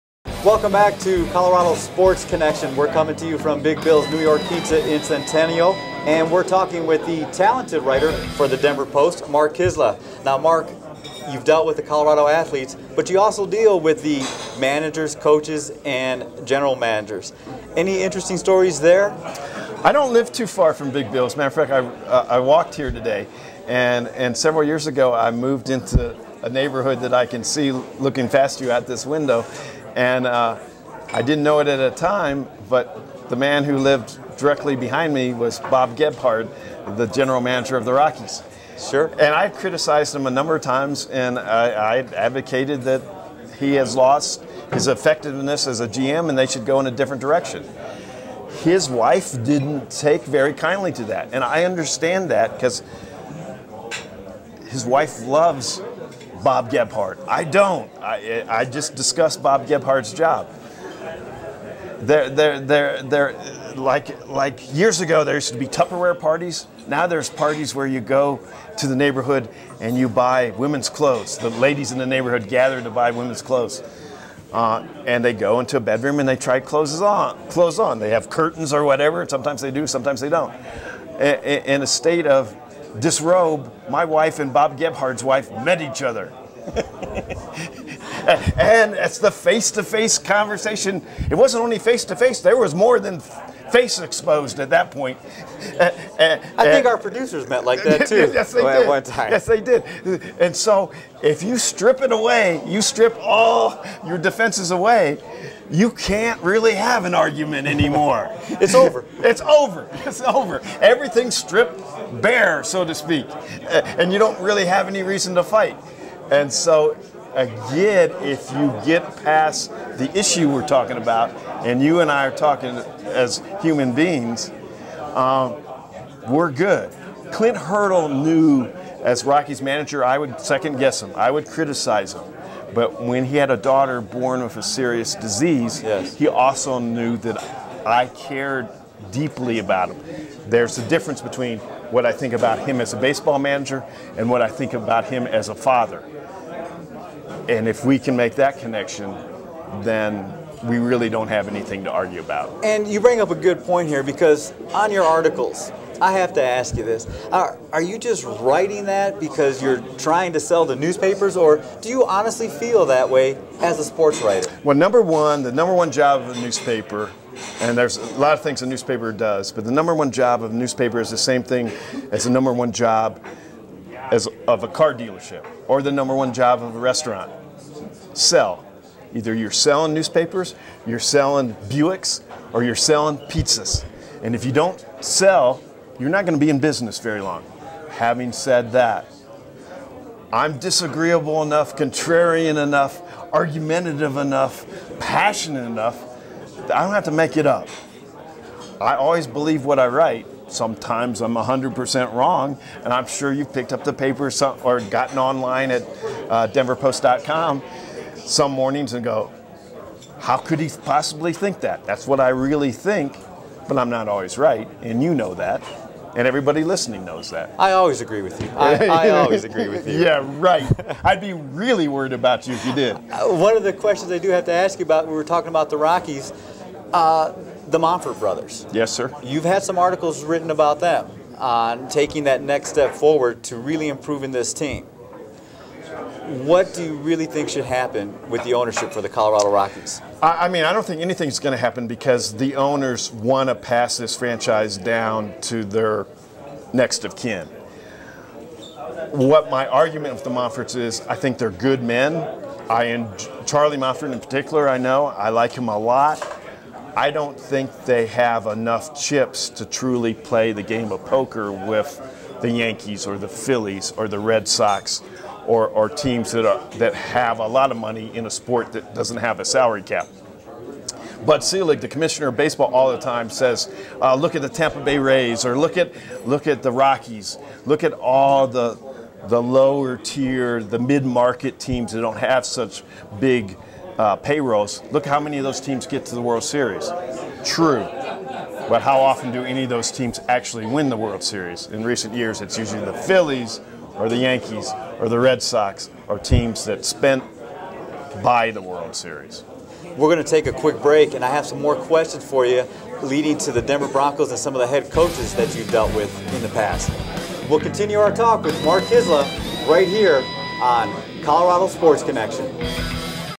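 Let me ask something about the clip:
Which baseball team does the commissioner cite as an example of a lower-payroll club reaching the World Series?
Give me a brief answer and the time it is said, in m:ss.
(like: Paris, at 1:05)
Tampa Bay Rays, at 4:34.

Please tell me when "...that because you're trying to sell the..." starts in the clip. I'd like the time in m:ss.
2:38.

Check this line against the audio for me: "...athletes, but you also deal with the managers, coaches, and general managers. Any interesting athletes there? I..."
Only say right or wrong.
wrong.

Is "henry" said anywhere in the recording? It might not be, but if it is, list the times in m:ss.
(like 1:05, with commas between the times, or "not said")
not said.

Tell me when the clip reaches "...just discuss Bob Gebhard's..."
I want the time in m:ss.
0:58.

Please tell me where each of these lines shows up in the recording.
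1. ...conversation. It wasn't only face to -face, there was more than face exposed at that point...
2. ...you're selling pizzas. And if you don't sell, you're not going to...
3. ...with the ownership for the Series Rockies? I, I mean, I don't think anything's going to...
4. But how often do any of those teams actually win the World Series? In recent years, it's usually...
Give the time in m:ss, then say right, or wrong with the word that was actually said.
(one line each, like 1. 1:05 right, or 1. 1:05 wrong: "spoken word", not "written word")
1. 1:30 right
2. 3:02 right
3. 3:58 wrong: "Colorado", not "Series"
4. 4:48 right.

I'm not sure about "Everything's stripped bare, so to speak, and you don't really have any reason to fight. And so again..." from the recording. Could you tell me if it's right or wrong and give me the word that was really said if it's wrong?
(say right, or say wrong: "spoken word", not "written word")
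right.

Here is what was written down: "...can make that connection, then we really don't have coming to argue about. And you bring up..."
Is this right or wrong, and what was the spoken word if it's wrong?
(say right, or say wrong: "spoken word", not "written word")
wrong: "anything", not "coming".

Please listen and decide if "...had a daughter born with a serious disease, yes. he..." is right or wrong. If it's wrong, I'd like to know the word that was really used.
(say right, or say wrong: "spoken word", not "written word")
right.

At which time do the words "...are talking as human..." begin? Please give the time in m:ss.
2:02.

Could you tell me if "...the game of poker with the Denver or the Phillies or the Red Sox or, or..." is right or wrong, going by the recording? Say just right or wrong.
wrong.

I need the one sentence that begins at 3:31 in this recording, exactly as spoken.
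That's what I really think, but I'm not always right, and you know that and everybody listening knows that.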